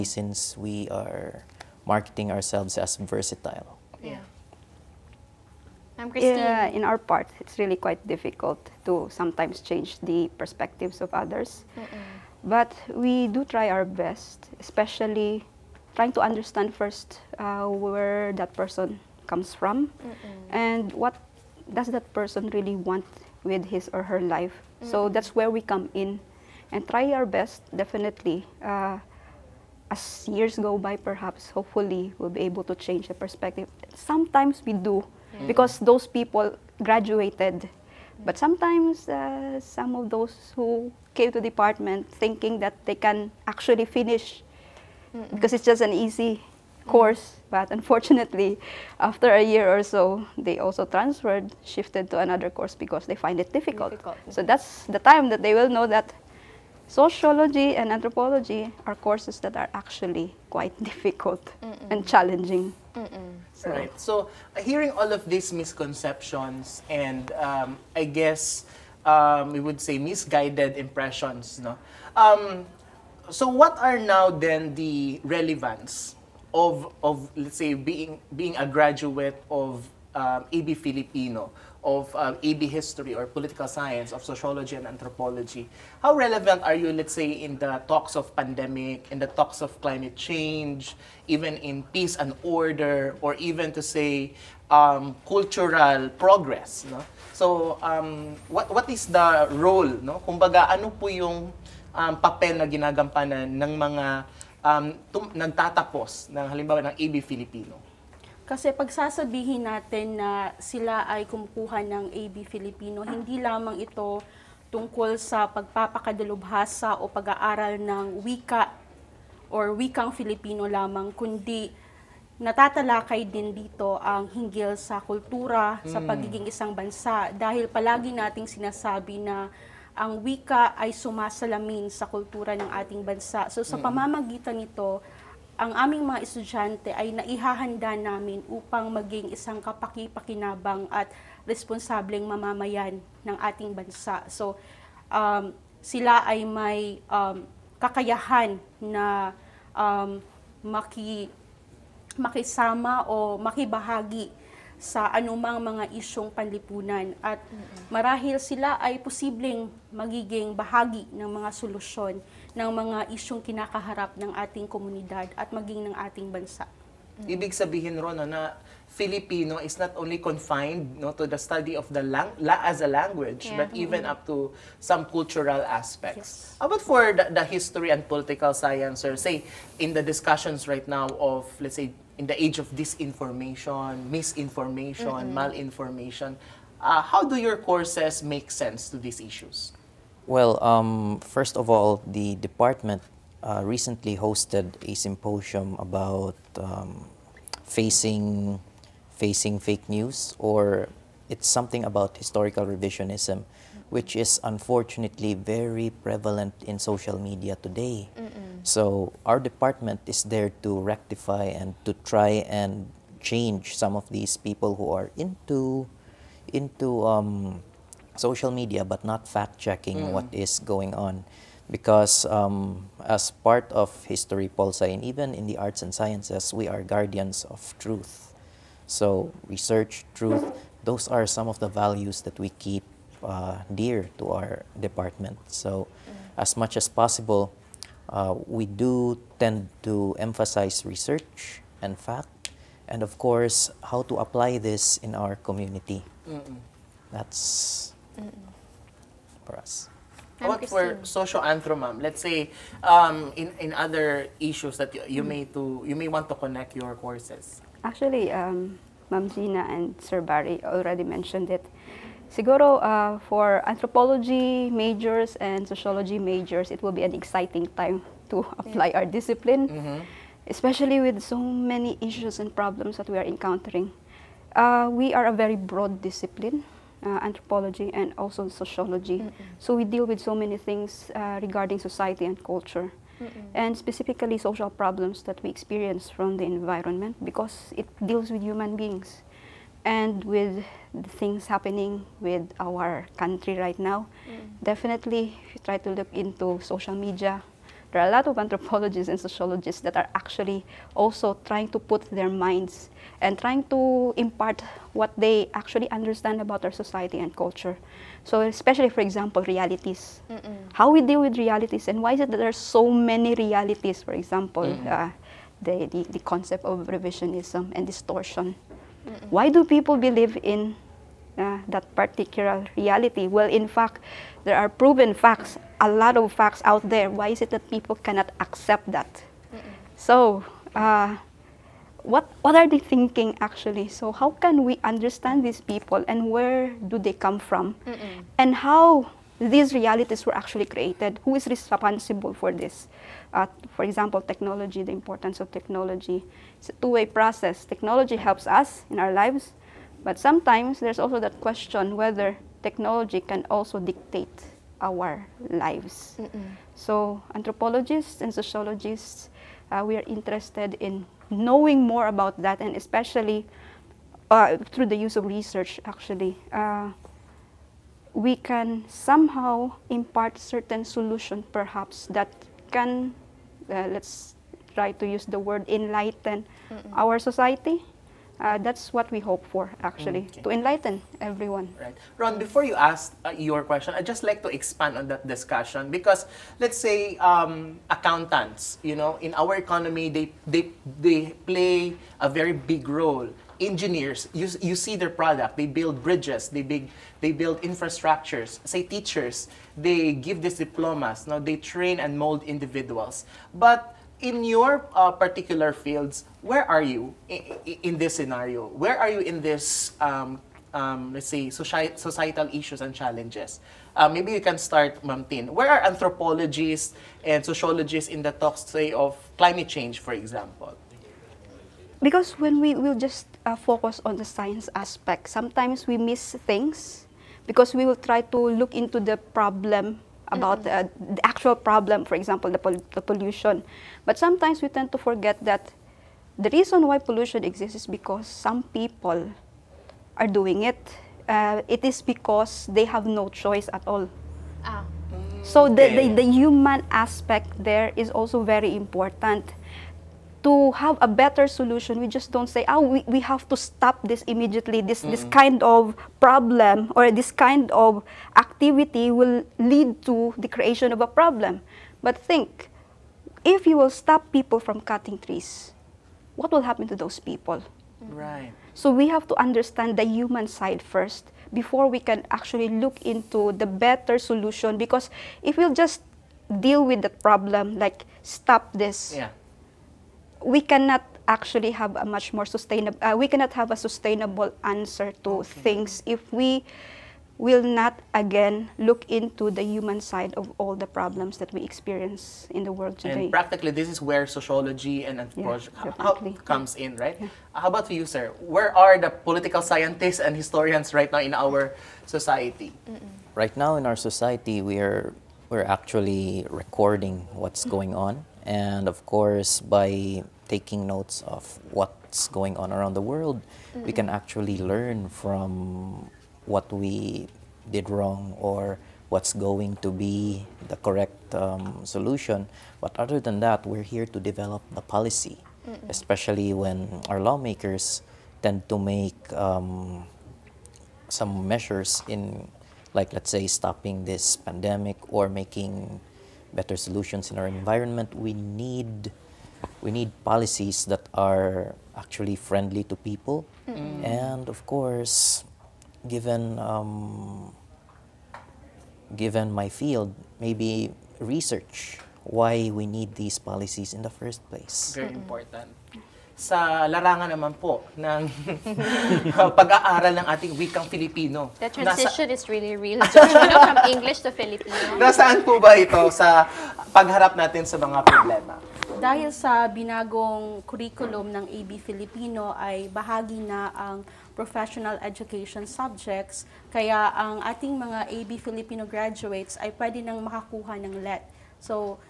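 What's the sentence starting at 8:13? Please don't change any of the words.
And practically, this is where sociology and anthropology yeah, comes in, right?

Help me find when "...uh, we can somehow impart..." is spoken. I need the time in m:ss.
6:06.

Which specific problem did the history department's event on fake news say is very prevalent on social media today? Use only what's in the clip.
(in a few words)
historical revisionism.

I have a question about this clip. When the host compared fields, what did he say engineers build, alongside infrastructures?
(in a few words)
bridges.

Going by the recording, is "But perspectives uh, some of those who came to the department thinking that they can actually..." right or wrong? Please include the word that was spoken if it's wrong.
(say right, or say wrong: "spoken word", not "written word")
wrong: "sometimes", not "perspectives".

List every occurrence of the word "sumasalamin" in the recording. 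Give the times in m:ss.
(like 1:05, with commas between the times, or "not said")
2:10.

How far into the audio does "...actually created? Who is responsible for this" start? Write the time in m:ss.
5:40.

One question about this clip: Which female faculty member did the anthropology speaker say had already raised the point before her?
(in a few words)
Ma'am Gina.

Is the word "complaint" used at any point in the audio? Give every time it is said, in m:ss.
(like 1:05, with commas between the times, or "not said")
not said.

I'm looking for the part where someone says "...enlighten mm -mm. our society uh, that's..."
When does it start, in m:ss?
6:15.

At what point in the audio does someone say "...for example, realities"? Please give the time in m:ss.
5:08.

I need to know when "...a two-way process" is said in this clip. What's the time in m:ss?
5:46.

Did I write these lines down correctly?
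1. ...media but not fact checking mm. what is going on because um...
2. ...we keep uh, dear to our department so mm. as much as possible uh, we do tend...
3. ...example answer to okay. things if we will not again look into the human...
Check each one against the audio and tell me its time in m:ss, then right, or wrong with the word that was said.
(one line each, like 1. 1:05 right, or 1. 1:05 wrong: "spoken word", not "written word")
1. 3:38 right
2. 3:52 right
3. 8:03 wrong: "sustainable", not "example".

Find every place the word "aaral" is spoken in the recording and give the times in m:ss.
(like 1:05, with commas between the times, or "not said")
1:57, 9:19.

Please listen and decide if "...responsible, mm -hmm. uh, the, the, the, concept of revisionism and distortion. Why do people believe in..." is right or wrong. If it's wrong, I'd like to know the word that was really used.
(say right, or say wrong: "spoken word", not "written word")
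wrong: "example", not "responsible".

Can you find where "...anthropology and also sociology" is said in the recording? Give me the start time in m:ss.
4:37.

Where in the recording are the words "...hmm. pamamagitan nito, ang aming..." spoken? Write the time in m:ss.
2:13.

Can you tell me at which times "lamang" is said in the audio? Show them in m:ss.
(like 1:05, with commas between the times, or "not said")
1:53, 2:00.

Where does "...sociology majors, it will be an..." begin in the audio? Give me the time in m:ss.
4:25.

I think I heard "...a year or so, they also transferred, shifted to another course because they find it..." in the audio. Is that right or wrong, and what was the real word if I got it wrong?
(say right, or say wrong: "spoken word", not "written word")
right.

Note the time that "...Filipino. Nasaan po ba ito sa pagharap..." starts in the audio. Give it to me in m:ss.
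9:24.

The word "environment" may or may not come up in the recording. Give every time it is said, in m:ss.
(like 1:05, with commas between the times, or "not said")
4:46, 8:57.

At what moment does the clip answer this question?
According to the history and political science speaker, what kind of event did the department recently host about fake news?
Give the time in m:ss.
3:14.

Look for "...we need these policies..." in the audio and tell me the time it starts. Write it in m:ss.
9:12.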